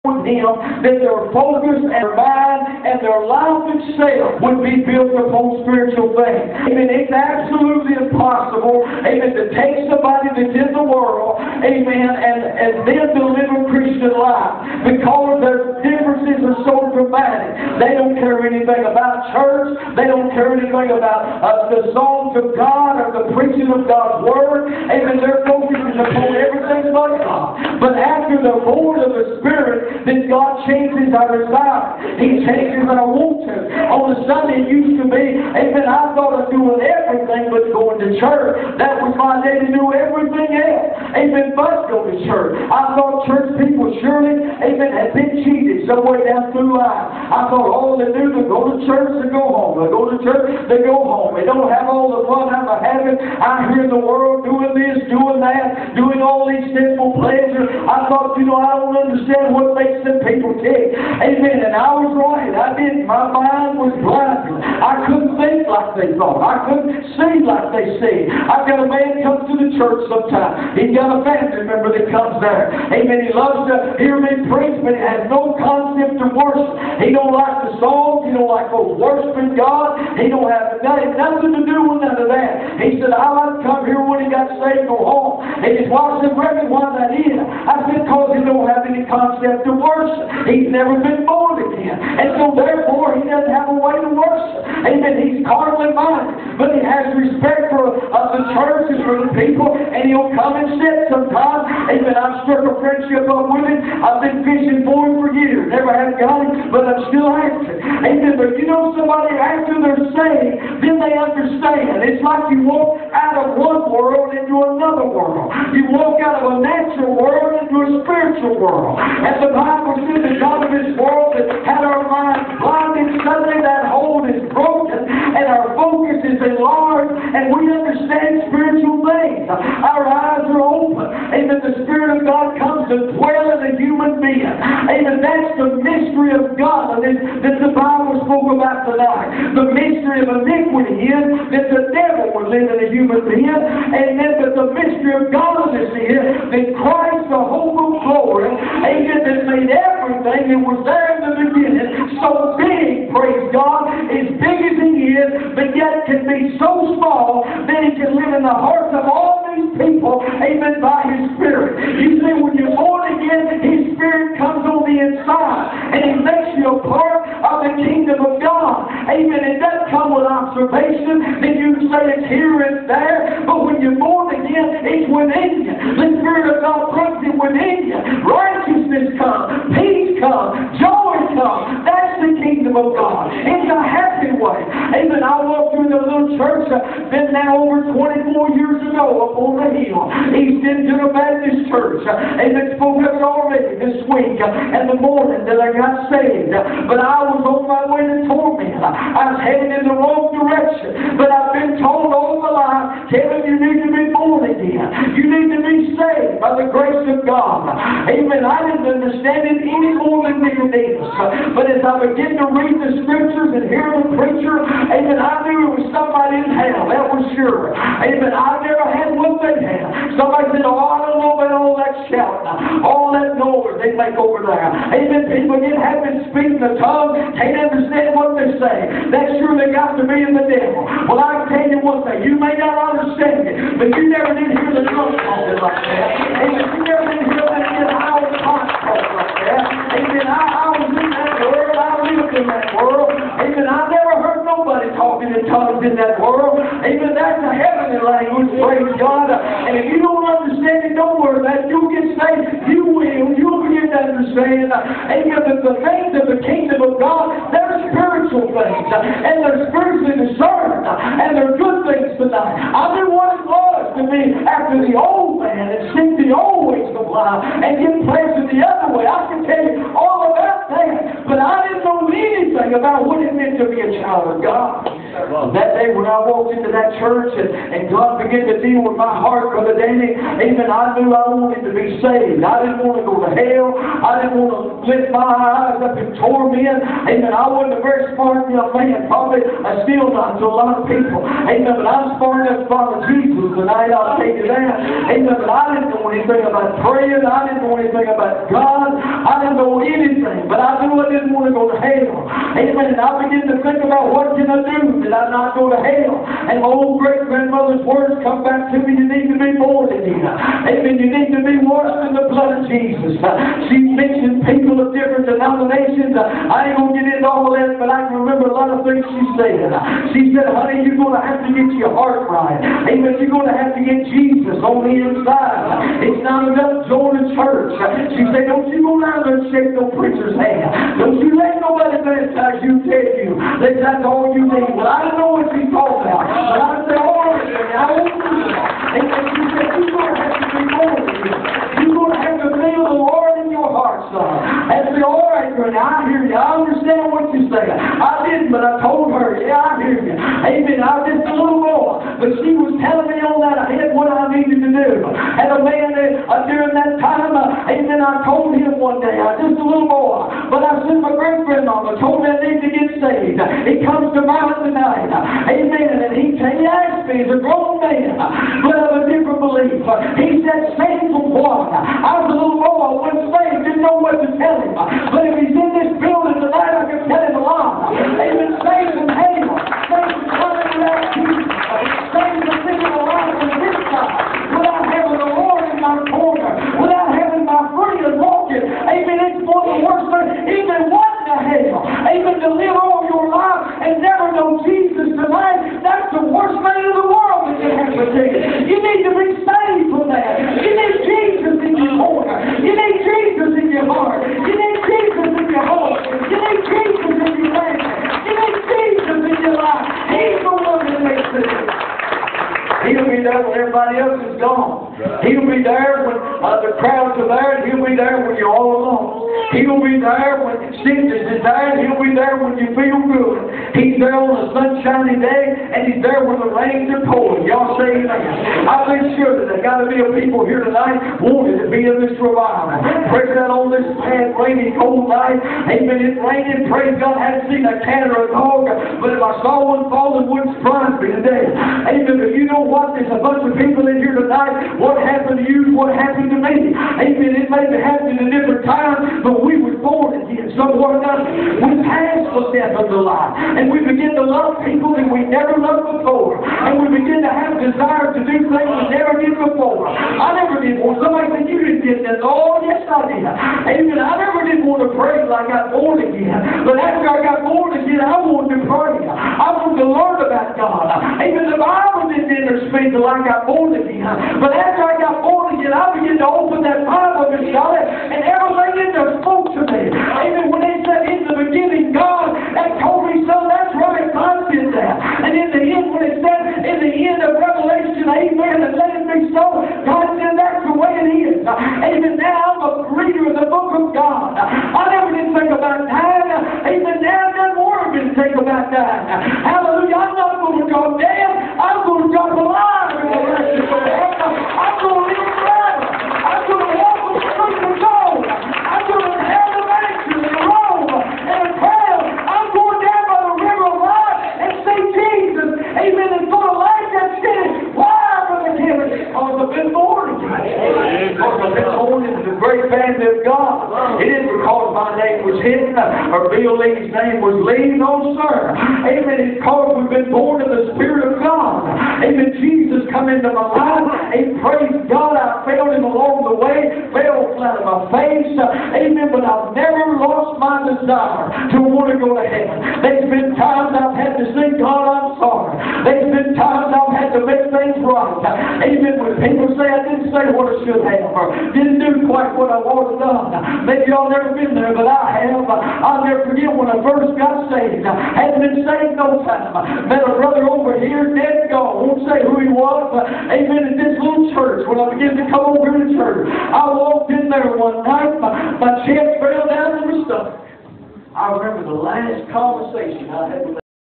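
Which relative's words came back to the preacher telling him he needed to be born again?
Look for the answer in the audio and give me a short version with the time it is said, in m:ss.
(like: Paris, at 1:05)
Great grandmother, at 5:07.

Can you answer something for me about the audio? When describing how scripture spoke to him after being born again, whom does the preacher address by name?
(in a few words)
Miss Charlotte.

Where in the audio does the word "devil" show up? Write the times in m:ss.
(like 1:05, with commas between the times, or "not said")
2:21, 3:50.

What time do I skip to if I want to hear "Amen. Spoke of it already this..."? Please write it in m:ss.
3:12.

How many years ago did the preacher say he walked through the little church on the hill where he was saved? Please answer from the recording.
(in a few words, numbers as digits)
24.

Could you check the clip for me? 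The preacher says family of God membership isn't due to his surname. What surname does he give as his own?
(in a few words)
Hinton.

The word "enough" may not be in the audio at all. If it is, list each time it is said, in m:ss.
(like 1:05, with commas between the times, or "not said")
4:52, 5:26.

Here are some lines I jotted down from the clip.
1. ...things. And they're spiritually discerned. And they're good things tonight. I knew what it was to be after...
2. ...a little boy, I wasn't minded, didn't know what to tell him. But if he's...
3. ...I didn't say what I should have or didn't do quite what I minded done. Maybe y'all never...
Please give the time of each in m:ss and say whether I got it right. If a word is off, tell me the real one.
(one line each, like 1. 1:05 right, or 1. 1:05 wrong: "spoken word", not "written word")
1. 4:18 right
2. 6:12 wrong: "saved", not "minded"
3. 9:09 wrong: "wanted", not "minded".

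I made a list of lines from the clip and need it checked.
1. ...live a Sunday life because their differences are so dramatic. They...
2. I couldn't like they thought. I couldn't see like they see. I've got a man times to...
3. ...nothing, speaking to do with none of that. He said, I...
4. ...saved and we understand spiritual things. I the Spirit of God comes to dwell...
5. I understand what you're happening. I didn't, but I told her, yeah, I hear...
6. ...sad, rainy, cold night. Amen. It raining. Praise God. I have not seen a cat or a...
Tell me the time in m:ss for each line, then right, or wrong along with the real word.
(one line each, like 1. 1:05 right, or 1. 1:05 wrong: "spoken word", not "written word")
1. 0:13 wrong: "Christian", not "Sunday"
2. 1:04 wrong: "comes", not "times"
3. 1:20 wrong: "nothing", not "speaking"
4. 2:06 wrong: "enlarged", not "saved"
5. 5:46 wrong: "saying", not "happening"
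6. 7:14 right.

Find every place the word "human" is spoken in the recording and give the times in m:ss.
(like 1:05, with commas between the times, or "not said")
2:13, 2:22.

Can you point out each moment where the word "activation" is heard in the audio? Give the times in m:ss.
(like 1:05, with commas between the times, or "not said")
not said.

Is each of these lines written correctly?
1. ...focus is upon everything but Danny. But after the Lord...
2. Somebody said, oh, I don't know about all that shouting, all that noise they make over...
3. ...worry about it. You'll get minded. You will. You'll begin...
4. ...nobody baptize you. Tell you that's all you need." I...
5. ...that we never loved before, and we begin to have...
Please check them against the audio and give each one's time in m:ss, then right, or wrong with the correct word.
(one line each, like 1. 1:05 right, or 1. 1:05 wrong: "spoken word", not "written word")
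1. 0:25 wrong: "God", not "Danny"
2. 3:40 right
3. 4:11 wrong: "saved", not "minded"
4. 5:31 right
5. 7:34 right.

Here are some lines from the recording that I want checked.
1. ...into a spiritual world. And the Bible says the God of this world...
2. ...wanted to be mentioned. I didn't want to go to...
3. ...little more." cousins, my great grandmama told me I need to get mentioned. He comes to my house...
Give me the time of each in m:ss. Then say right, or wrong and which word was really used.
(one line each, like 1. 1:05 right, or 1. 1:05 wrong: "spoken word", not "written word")
1. 1:57 right
2. 4:41 wrong: "saved", not "mentioned"
3. 5:59 wrong: "saved", not "mentioned".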